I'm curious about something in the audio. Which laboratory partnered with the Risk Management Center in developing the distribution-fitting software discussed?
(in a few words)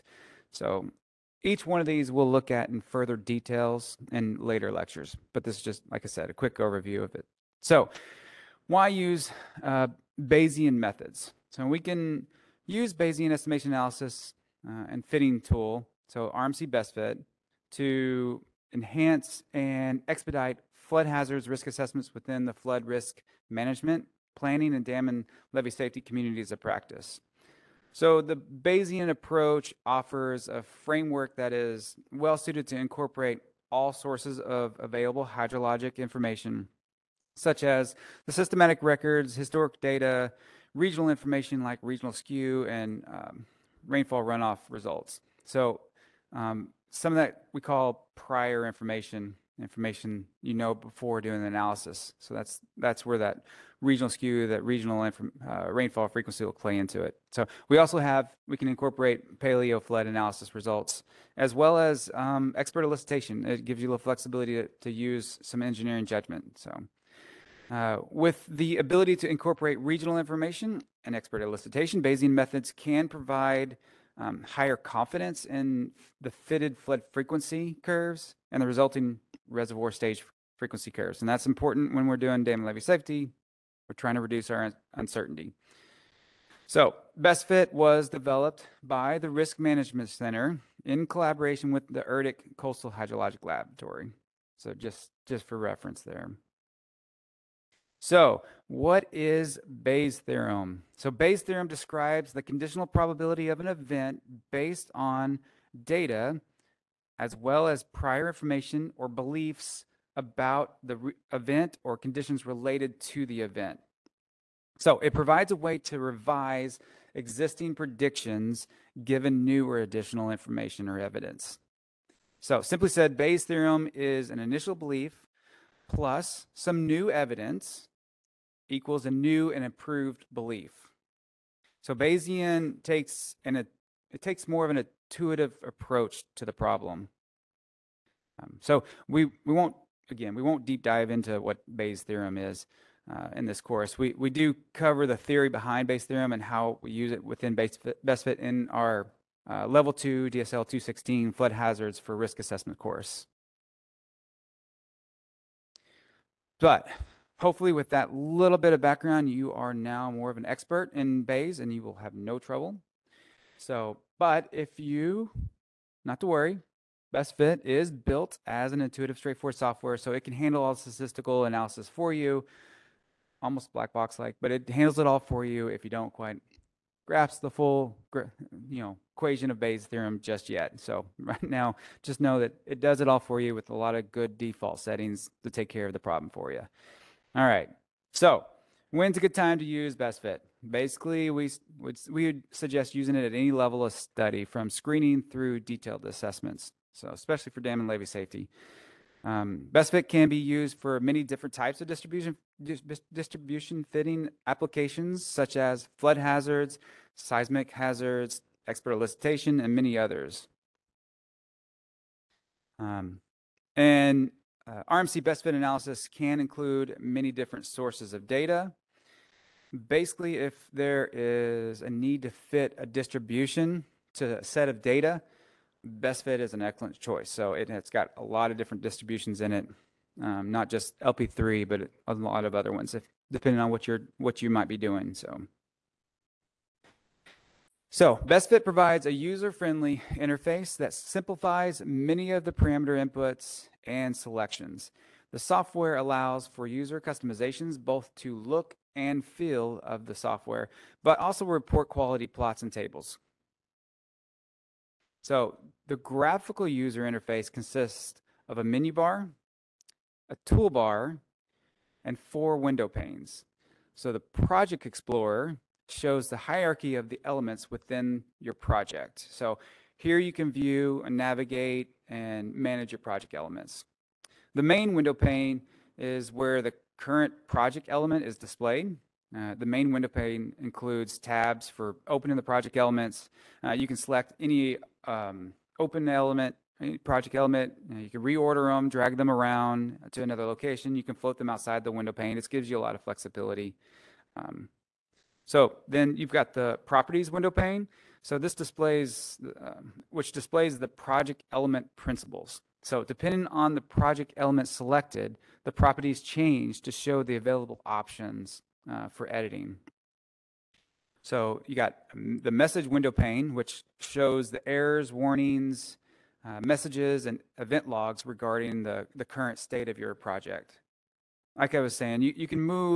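ERDC Coastal Hydrologic Laboratory.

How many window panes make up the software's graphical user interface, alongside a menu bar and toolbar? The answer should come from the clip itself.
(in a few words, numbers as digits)
4.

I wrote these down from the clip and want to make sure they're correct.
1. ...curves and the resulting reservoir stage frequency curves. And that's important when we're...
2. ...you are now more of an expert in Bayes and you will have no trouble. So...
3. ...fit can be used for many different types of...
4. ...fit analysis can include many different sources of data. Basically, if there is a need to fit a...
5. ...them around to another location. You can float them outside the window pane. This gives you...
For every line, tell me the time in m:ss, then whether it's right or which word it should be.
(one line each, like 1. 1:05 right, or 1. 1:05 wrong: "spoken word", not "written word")
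1. 1:17 right
2. 2:39 right
3. 3:19 right
4. 3:35 right
5. 4:49 right.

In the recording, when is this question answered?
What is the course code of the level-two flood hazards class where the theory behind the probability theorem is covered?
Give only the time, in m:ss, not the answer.
2:30.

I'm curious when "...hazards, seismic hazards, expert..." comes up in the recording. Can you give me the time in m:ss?
3:26.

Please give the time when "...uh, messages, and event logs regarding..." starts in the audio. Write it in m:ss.
5:16.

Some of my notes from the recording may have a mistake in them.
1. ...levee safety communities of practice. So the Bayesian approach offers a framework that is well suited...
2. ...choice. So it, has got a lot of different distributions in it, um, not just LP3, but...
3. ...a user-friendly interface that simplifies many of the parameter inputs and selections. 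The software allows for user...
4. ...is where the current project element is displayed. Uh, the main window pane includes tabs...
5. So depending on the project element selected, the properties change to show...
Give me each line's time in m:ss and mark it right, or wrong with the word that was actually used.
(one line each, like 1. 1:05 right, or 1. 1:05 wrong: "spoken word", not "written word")
1. 0:25 right
2. 3:46 right
3. 3:59 right
4. 4:35 right
5. 5:02 right.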